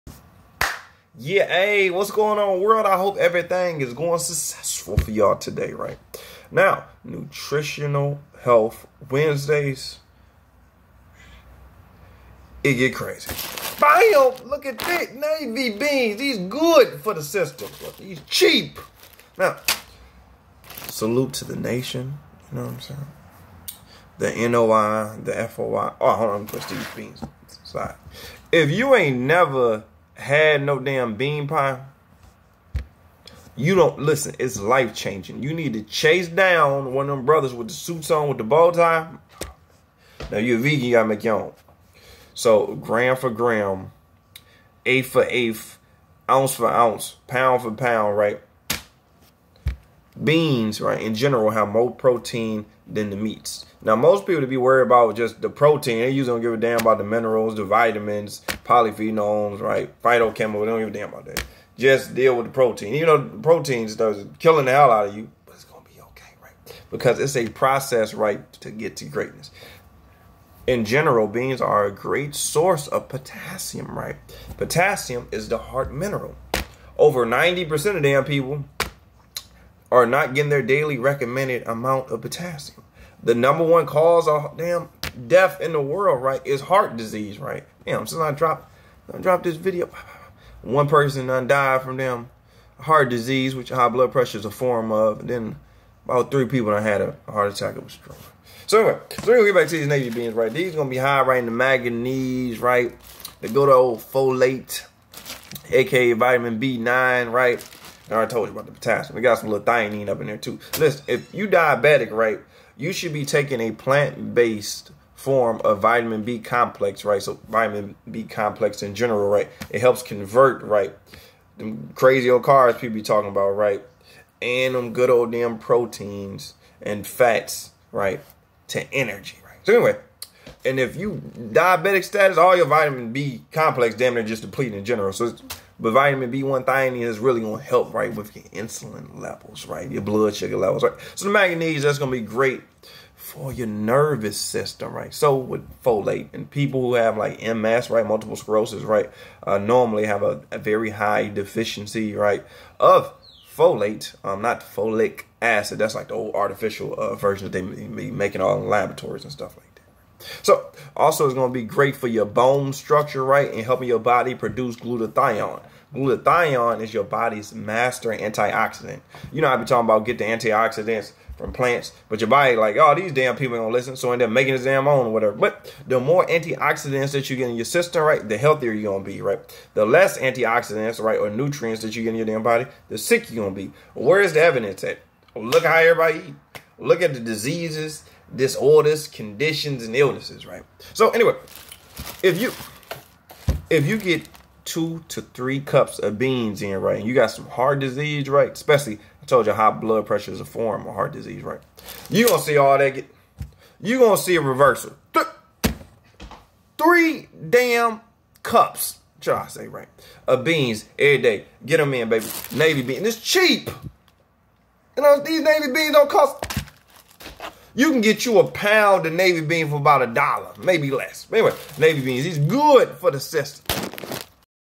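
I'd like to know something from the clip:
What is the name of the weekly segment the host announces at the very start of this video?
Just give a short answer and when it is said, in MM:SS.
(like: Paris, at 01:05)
Nutritional Health Wednesdays, at 00:07.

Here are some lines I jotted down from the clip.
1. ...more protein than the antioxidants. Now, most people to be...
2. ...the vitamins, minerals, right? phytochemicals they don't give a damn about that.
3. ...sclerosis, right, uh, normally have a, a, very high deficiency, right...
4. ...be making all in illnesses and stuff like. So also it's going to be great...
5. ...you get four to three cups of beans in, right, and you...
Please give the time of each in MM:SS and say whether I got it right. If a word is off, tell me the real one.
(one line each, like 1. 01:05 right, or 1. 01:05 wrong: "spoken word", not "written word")
1. 00:51 wrong: "meats", not "antioxidants"
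2. 00:57 wrong: "polyphenols", not "minerals"
3. 02:28 right
4. 02:37 wrong: "laboratories", not "illnesses"
5. 03:13 wrong: "two", not "four".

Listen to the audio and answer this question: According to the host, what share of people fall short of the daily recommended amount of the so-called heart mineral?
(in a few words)
Over 90%.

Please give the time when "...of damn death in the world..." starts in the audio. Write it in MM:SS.
01:24.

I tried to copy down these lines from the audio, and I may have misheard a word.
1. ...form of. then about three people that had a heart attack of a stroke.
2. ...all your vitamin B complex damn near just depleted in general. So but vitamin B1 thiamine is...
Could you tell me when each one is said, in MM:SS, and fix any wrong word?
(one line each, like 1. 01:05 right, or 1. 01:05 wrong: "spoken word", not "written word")
1. 01:34 right
2. 02:12 right.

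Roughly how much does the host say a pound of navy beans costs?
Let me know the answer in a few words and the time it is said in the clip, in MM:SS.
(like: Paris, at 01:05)
about a dollar, at 03:39.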